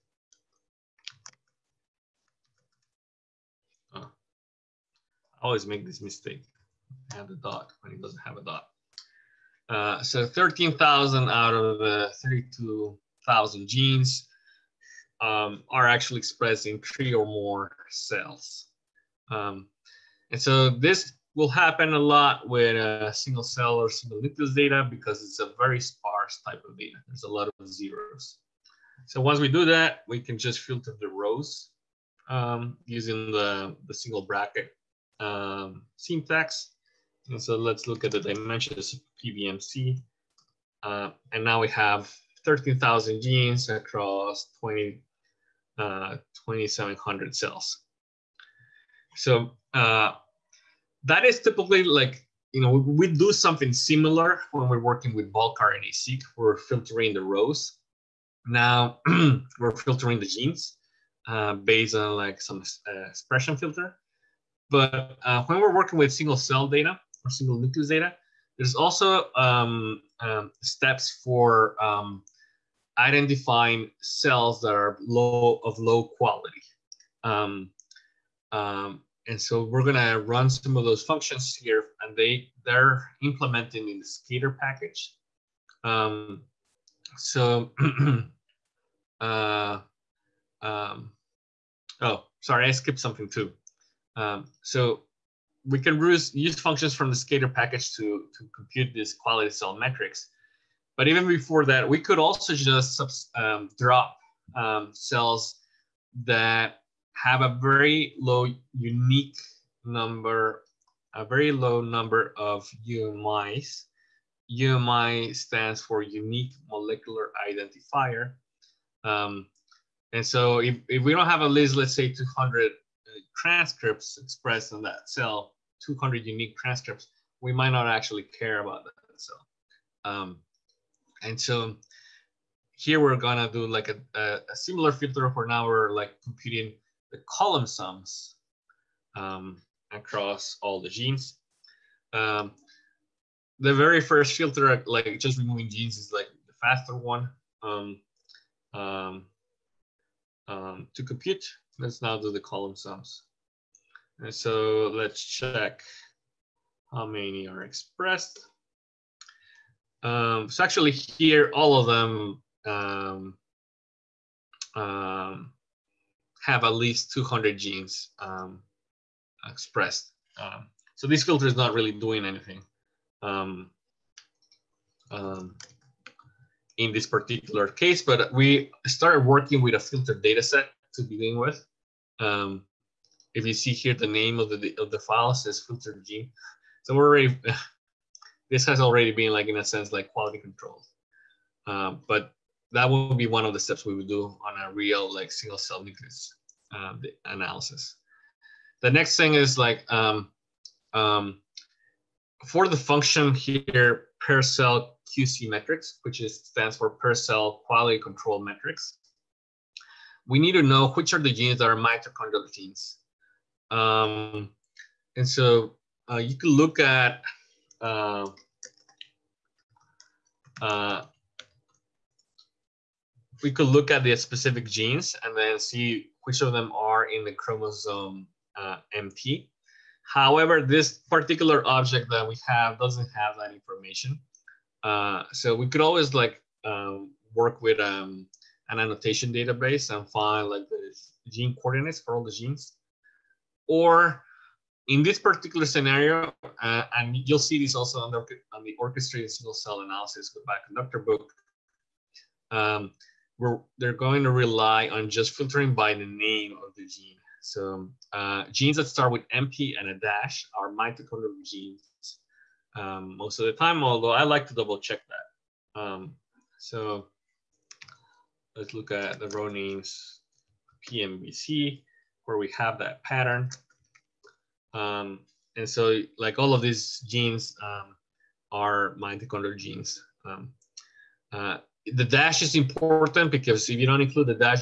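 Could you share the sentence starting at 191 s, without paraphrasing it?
Uh, but that would be one of the steps we would do on a real like single cell nucleus uh, analysis.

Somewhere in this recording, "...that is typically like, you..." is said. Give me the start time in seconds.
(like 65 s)
51 s.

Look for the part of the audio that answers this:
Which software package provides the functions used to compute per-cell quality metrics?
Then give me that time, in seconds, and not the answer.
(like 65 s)
97 s.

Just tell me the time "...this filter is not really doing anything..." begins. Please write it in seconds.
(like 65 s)
171 s.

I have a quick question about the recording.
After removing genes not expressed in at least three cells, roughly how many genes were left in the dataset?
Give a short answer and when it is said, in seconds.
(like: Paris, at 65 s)
13,000, at 42 s.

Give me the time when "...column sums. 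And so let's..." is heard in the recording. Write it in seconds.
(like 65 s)
152 s.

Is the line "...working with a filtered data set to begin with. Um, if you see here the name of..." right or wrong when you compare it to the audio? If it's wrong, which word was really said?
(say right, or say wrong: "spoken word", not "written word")
right.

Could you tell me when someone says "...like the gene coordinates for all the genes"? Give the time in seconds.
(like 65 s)
240 s.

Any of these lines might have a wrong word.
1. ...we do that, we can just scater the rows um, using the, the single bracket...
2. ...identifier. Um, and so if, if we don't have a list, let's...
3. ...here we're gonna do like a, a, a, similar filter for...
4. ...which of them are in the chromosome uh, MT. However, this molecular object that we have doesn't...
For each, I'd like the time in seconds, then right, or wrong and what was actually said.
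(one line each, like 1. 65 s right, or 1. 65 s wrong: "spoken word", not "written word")
1. 29 s wrong: "filter", not "scater"
2. 117 s right
3. 132 s right
4. 226 s wrong: "particular", not "molecular".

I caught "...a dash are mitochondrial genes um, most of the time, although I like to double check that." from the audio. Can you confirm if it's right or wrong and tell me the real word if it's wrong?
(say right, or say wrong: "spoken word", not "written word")
right.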